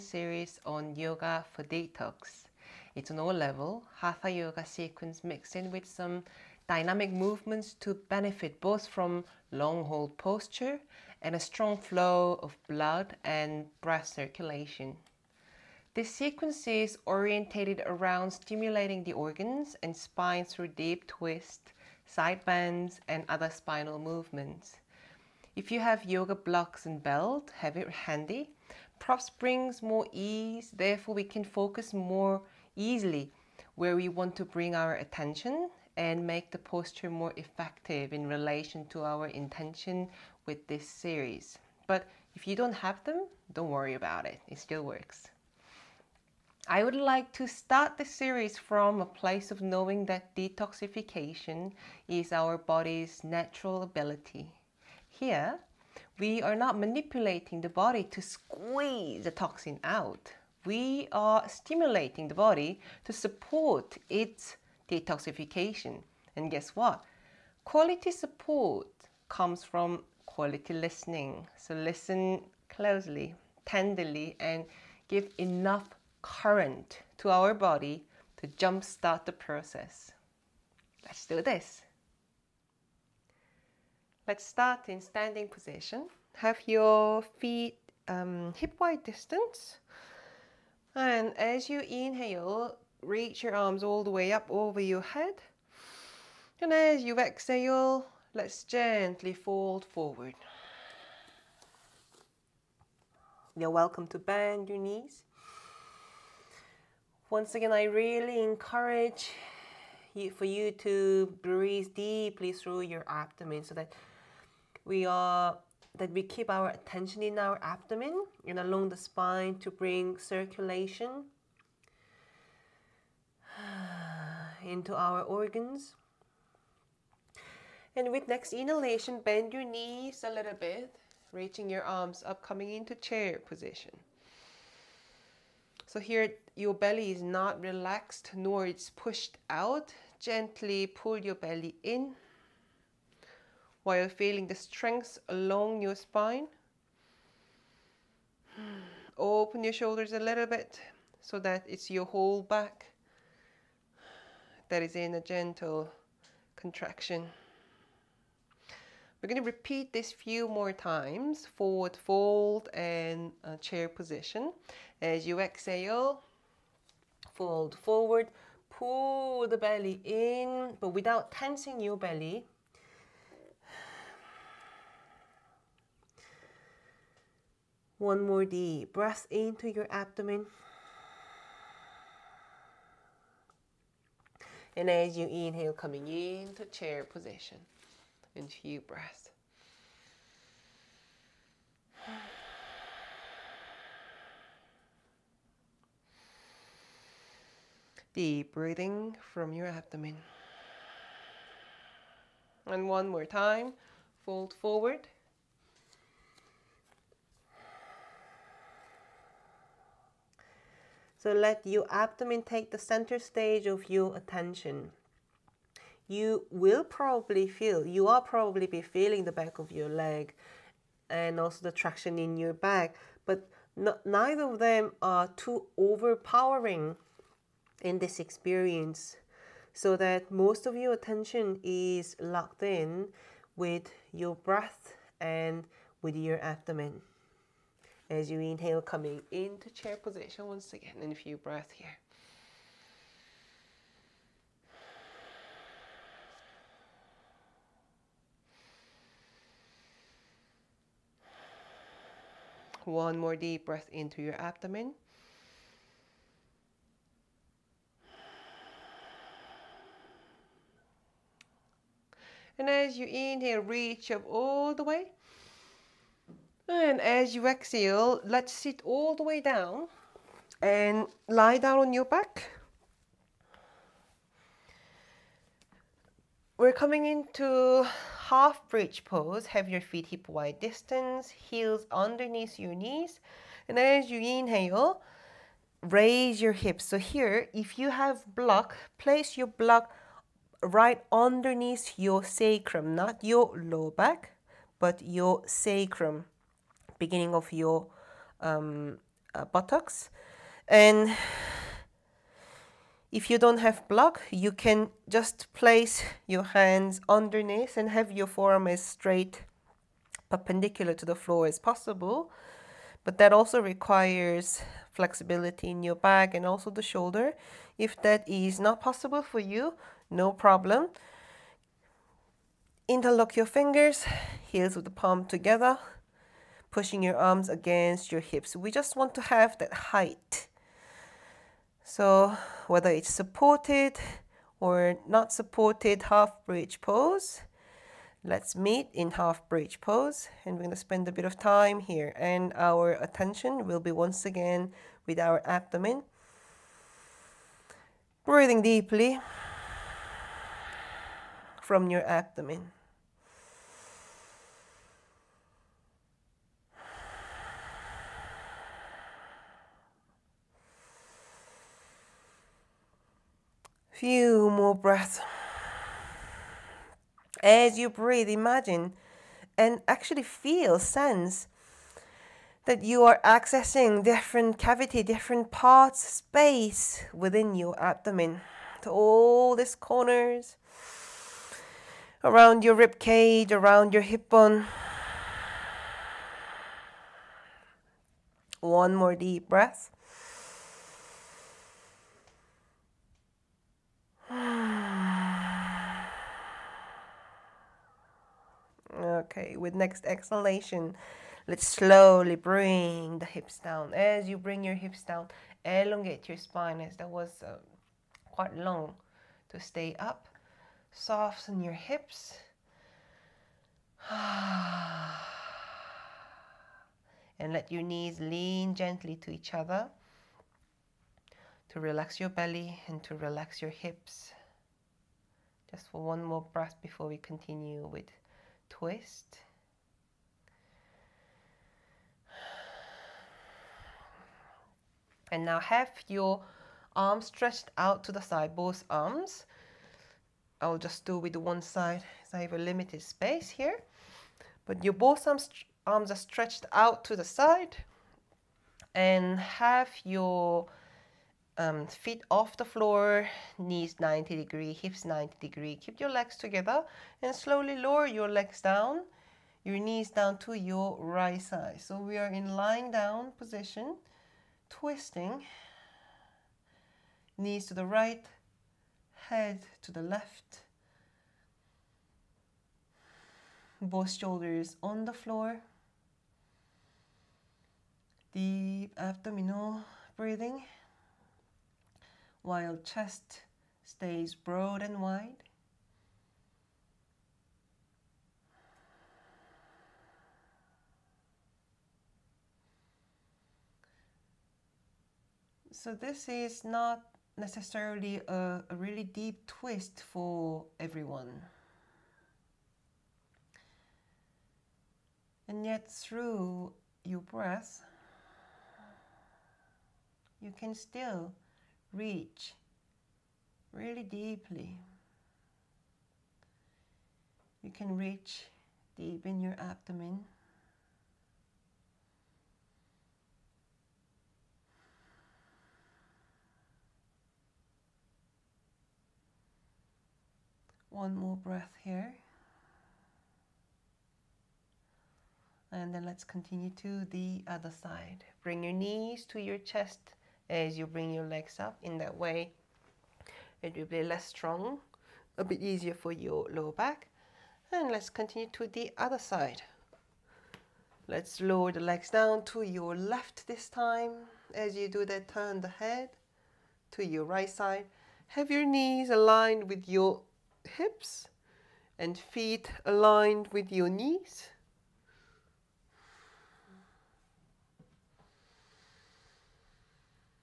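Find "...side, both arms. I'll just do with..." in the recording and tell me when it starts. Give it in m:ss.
7:18.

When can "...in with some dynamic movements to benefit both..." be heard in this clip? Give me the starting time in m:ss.
0:05.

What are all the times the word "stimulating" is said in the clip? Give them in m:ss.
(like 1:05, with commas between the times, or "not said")
0:18, 1:01.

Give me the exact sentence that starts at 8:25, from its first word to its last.
And yet through your breath, you can still reach really deeply.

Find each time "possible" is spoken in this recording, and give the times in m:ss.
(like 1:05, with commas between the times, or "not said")
5:11, 5:18.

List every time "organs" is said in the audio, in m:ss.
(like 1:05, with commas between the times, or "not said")
0:19, 2:05.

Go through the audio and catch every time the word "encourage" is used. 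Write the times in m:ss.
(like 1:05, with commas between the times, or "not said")
1:48.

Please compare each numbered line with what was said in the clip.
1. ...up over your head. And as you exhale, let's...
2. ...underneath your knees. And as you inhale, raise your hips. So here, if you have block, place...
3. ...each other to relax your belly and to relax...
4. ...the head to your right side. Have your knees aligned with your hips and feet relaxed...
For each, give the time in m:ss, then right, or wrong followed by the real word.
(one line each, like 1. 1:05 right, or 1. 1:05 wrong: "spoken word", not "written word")
1. 1:34 right
2. 4:41 right
3. 6:59 right
4. 9:15 wrong: "aligned", not "relaxed".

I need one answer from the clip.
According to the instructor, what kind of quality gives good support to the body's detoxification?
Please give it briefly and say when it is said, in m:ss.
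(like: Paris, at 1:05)
Quality listening, at 1:10.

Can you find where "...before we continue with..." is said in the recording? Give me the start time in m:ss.
7:06.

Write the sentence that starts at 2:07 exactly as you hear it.
And with next inhalation, bend your knees a little bit, reaching your arms up, coming into chair position.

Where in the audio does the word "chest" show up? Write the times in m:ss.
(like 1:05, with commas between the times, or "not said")
8:02, 8:59.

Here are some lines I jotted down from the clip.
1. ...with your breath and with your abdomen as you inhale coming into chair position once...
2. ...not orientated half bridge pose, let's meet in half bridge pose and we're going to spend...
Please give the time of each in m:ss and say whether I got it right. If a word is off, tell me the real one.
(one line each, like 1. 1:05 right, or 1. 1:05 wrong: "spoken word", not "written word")
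1. 3:53 right
2. 5:35 wrong: "supported", not "orientated".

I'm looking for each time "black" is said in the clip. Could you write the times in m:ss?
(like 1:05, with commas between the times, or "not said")
not said.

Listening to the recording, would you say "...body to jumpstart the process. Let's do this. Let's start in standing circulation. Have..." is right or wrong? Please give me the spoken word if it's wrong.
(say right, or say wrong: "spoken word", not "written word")
wrong: "position", not "circulation".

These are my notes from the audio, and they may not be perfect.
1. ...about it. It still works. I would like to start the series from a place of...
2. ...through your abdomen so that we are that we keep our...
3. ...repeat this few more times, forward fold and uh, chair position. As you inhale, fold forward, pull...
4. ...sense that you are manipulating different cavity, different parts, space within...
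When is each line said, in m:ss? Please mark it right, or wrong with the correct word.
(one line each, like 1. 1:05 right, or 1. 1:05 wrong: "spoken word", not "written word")
1. 0:43 right
2. 1:52 right
3. 2:39 wrong: "exhale", not "inhale"
4. 6:10 wrong: "accessing", not "manipulating".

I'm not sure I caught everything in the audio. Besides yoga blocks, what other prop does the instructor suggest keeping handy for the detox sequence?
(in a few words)
Belt.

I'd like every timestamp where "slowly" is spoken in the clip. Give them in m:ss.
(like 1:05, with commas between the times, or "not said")
6:41, 7:37.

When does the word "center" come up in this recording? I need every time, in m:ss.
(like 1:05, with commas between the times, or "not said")
3:32.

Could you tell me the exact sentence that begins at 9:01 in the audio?
In that way, it will be less strong, a bit easier for your lower back.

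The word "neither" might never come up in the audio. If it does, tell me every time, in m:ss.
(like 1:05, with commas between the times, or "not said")
3:44.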